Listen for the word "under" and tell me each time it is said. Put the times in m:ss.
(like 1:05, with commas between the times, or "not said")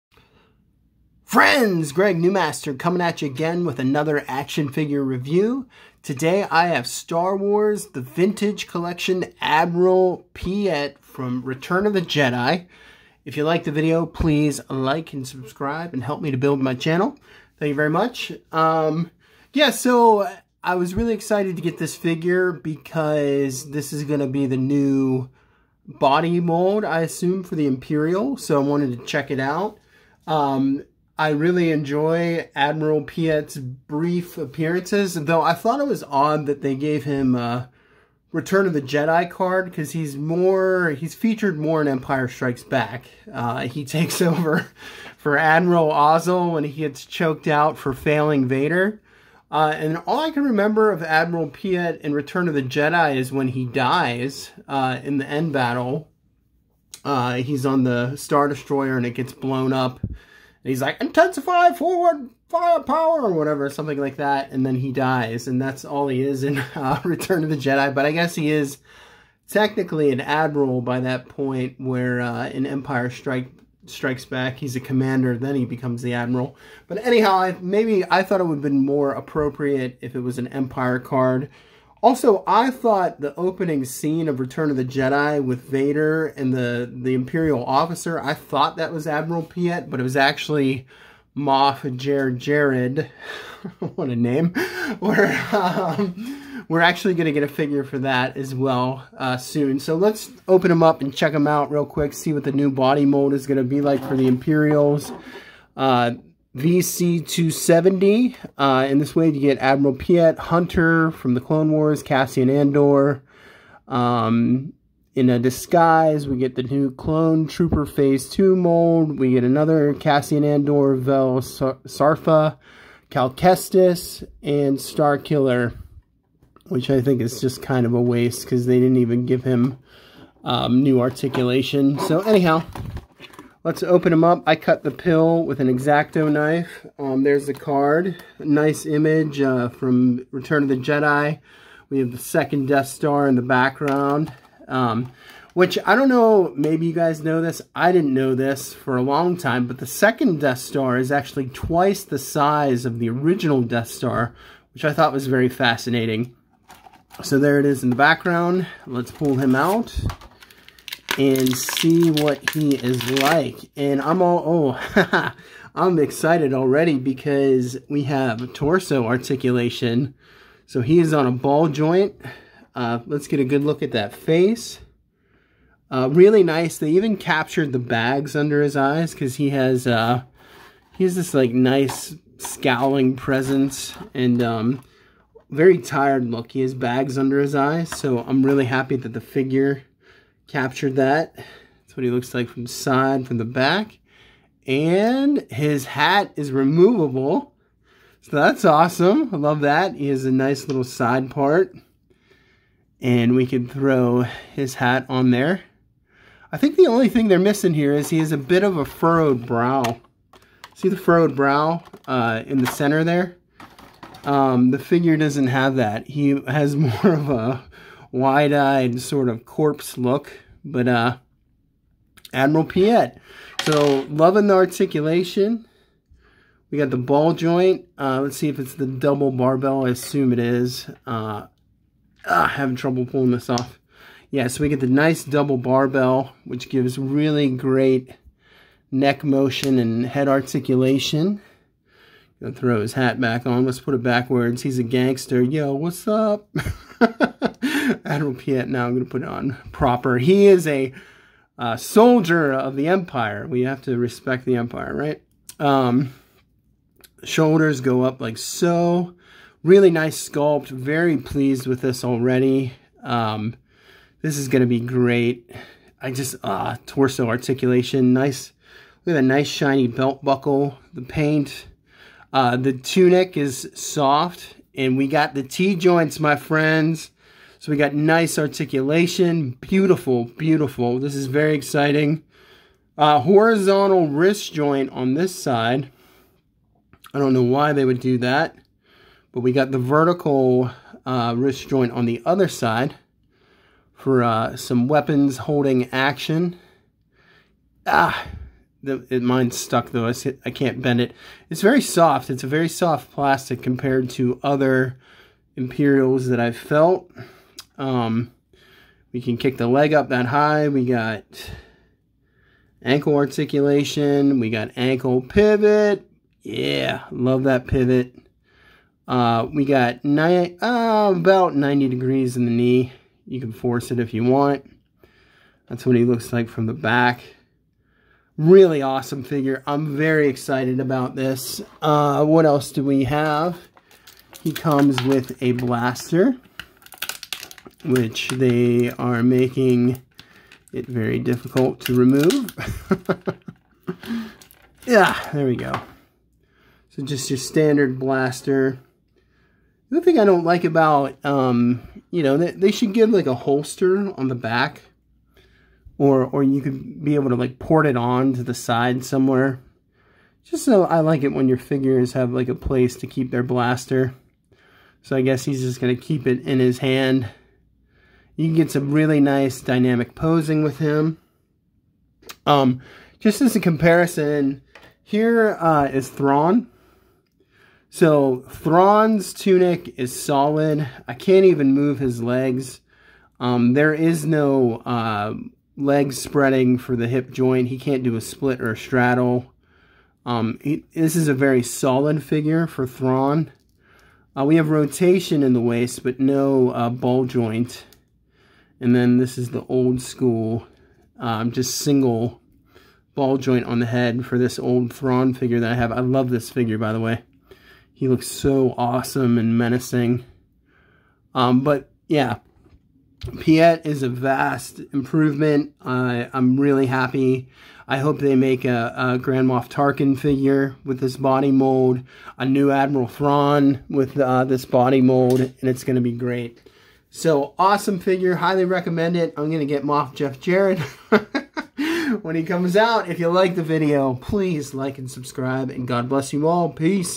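2:58, 3:07.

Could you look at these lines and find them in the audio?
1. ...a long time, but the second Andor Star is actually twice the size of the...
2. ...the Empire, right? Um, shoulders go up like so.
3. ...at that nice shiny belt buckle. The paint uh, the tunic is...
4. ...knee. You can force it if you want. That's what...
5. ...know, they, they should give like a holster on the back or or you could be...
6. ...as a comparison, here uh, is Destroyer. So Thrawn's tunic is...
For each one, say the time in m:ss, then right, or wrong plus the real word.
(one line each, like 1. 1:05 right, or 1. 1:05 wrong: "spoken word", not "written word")
1. 2:28 wrong: "Death", not "Andor"
2. 4:14 right
3. 4:29 right
4. 5:22 right
5. 5:52 right
6. 6:13 wrong: "Thrawn", not "Destroyer".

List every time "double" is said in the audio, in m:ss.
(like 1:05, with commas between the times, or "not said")
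3:48, 3:55.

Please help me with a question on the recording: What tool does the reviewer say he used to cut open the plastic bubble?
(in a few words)
Exacto knife.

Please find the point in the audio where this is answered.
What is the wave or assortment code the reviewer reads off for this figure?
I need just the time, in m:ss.
1:46.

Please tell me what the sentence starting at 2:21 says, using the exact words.
We have the second Death Star in the background.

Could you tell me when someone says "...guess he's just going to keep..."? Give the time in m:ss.
6:05.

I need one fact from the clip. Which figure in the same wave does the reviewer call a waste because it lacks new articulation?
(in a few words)
Star Killer.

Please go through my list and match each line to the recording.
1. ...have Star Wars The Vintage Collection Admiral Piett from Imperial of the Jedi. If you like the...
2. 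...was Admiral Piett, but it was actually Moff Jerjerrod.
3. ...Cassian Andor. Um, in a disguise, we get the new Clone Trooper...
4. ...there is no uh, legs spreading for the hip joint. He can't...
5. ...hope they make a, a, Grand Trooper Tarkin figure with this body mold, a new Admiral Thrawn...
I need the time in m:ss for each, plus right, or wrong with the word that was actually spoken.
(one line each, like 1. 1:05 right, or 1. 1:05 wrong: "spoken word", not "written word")
1. 0:06 wrong: "Return", not "Imperial"
2. 1:28 right
3. 1:52 right
4. 6:23 right
5. 6:57 wrong: "Moff", not "Trooper".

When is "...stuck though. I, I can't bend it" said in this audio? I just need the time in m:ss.
4:59.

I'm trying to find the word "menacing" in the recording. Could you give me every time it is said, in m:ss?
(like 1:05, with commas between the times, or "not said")
6:49.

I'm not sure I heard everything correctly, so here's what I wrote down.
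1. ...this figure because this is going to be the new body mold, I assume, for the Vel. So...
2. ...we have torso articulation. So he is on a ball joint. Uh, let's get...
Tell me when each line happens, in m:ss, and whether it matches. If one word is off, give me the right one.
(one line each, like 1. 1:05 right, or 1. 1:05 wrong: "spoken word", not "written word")
1. 0:21 wrong: "Imperial", not "Vel"
2. 2:47 right.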